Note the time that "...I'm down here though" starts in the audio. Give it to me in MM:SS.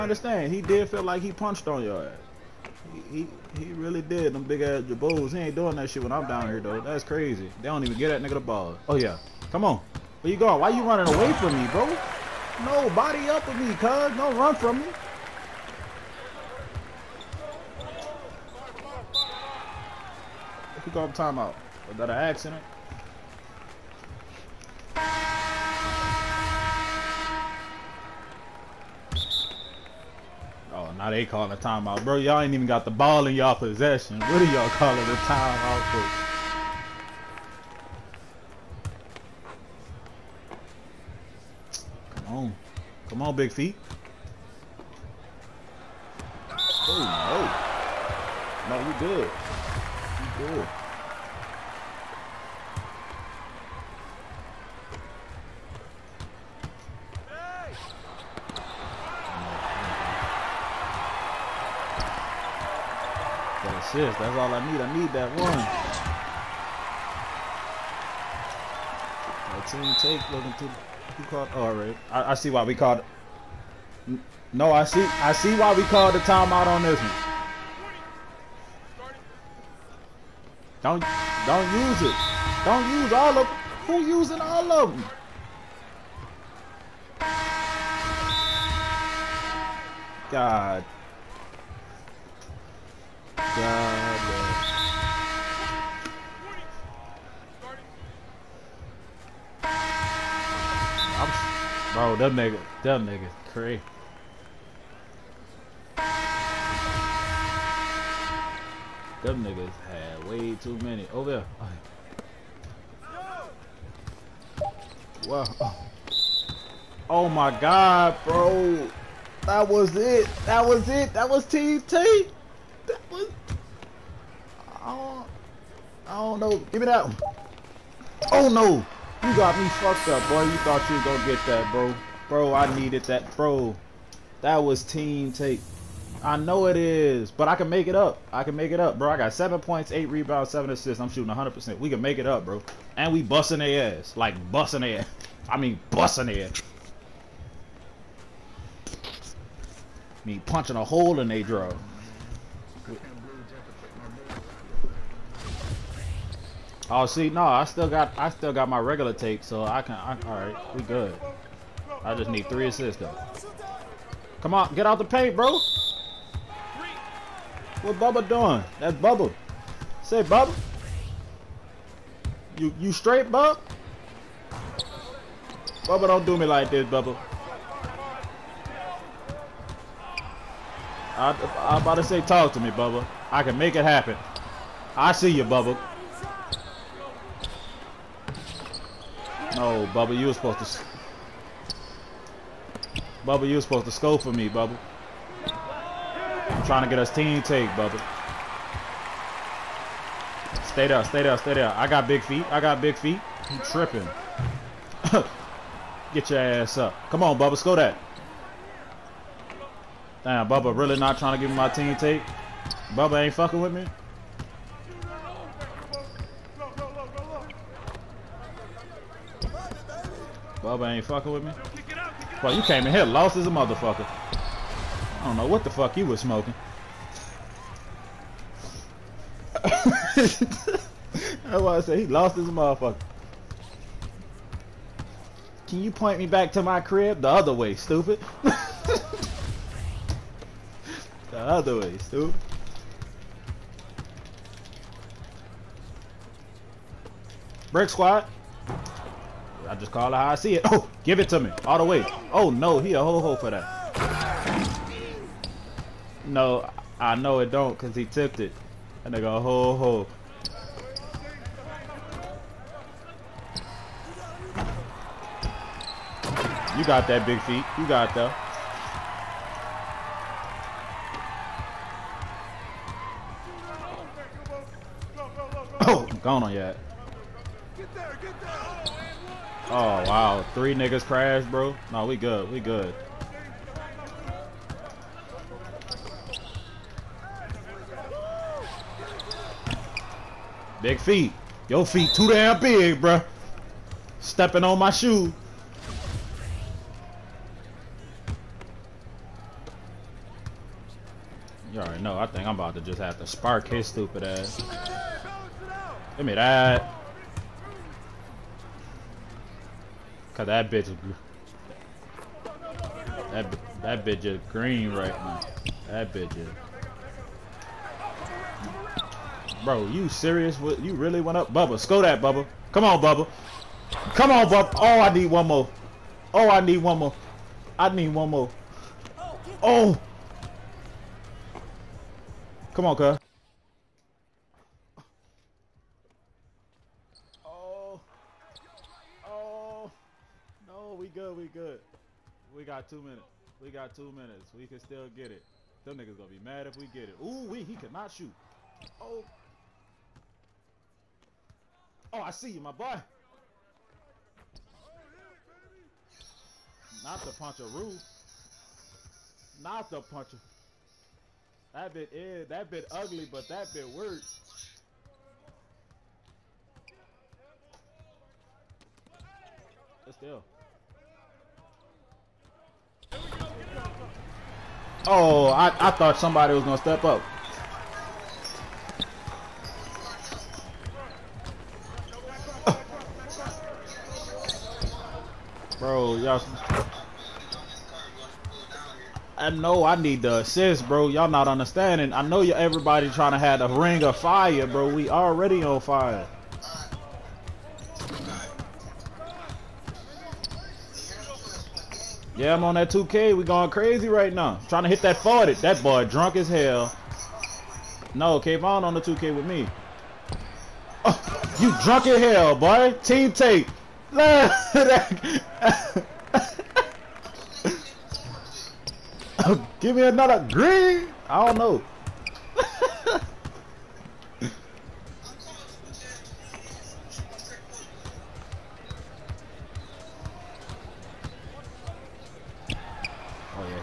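00:06.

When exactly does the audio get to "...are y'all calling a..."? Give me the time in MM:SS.
00:34.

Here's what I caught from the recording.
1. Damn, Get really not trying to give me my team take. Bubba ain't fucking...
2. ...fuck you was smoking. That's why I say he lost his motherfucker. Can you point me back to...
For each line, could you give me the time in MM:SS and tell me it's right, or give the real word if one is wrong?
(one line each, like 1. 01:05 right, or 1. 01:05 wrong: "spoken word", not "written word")
1. 03:30 wrong: "Bubba", not "Get"
2. 03:45 right.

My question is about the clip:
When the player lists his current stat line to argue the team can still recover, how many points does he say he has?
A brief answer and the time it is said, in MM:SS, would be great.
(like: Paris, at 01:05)
7, at 02:19.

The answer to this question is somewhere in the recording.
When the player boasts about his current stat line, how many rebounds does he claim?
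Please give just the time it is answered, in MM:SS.
02:19.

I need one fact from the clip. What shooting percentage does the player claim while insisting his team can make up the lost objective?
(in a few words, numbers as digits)
100%.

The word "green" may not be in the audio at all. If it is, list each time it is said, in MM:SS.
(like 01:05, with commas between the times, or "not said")
05:14, 07:00.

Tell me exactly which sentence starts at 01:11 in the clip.
All right, I, I see why we called.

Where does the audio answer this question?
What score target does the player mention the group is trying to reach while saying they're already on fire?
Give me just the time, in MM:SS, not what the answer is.
06:45.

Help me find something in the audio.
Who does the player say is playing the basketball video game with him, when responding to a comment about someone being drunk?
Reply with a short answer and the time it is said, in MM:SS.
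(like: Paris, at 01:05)
Kayvon, at 06:48.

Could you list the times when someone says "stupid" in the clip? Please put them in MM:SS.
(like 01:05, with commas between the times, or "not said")
03:57, 04:01, 05:03.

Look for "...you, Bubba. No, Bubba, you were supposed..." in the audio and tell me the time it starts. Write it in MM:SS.
03:05.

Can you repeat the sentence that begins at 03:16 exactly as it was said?
I'm trying to get us team take, Bubba.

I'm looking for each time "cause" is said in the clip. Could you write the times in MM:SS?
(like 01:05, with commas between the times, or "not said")
04:17, 05:10.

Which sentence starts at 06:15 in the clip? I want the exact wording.
Oh, I, I thought somebody was gonna step up.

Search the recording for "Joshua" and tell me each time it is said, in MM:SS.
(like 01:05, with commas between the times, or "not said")
not said.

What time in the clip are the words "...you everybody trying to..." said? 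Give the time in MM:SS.
06:32.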